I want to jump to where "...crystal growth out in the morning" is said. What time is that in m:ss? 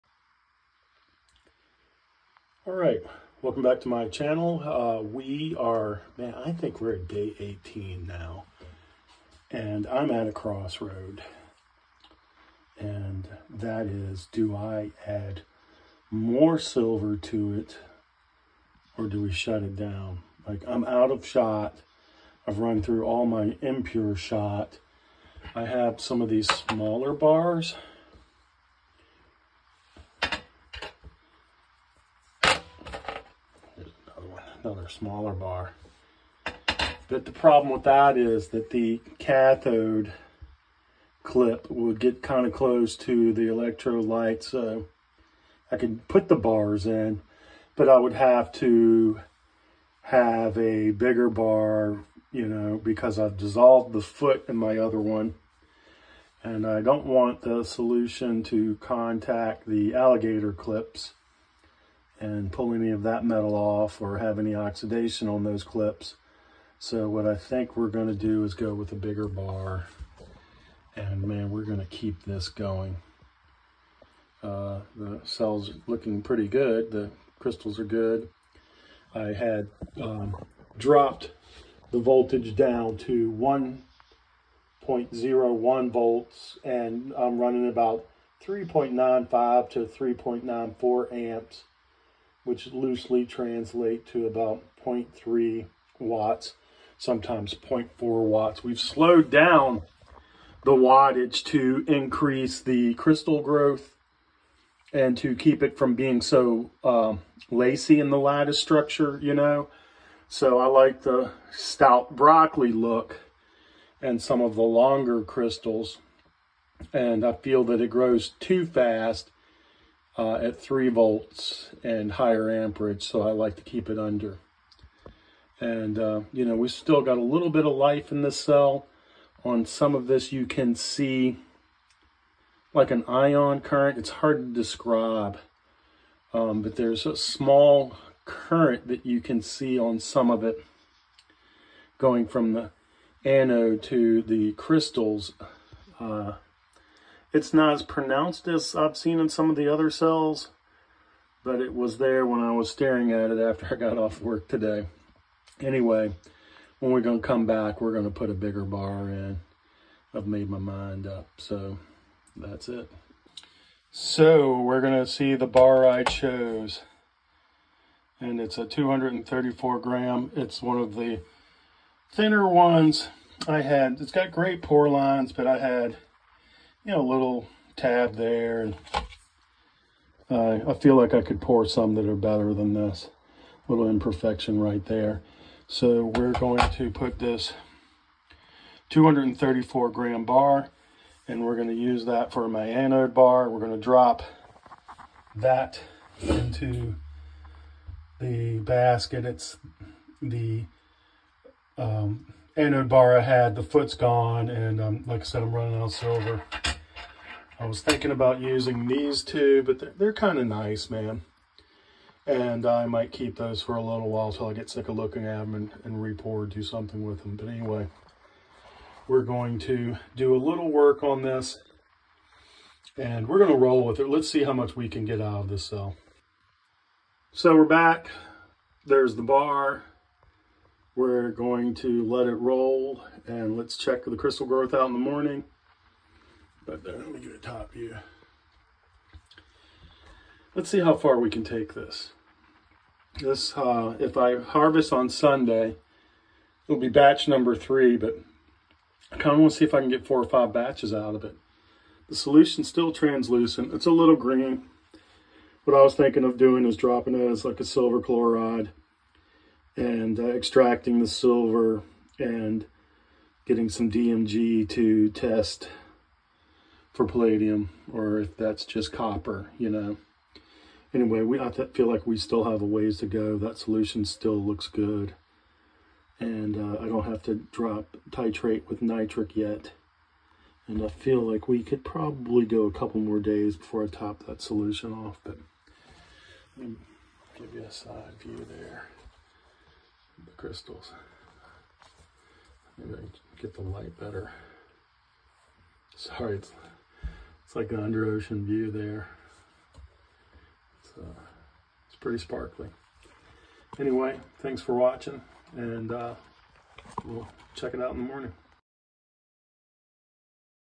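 3:54.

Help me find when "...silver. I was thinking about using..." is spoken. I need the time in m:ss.
3:25.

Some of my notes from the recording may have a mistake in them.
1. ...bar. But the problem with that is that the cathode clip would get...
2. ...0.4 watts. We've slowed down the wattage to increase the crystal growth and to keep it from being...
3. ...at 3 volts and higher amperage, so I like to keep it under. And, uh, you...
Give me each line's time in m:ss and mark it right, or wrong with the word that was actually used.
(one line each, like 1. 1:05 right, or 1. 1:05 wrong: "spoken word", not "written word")
1. 0:35 right
2. 1:37 right
3. 2:00 right.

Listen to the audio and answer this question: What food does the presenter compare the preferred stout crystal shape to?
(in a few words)
broccoli.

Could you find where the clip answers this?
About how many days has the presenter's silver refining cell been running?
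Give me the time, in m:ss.
0:07.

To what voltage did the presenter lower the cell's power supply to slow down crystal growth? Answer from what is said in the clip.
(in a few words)
1.01 volts.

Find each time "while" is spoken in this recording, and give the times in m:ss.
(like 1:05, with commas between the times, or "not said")
3:34.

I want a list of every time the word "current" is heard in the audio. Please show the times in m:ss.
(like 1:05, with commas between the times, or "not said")
2:13, 2:18.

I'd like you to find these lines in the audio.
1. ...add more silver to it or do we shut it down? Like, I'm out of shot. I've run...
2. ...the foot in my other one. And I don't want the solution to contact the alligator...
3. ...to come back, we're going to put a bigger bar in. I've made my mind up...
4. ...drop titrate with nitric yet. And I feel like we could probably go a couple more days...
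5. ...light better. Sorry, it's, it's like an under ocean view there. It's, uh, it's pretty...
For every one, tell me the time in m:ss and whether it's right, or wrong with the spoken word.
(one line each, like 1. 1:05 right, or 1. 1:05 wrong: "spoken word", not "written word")
1. 0:15 right
2. 0:53 right
3. 2:37 right
4. 4:37 right
5. 4:53 right.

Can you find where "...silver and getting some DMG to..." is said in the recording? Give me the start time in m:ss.
4:21.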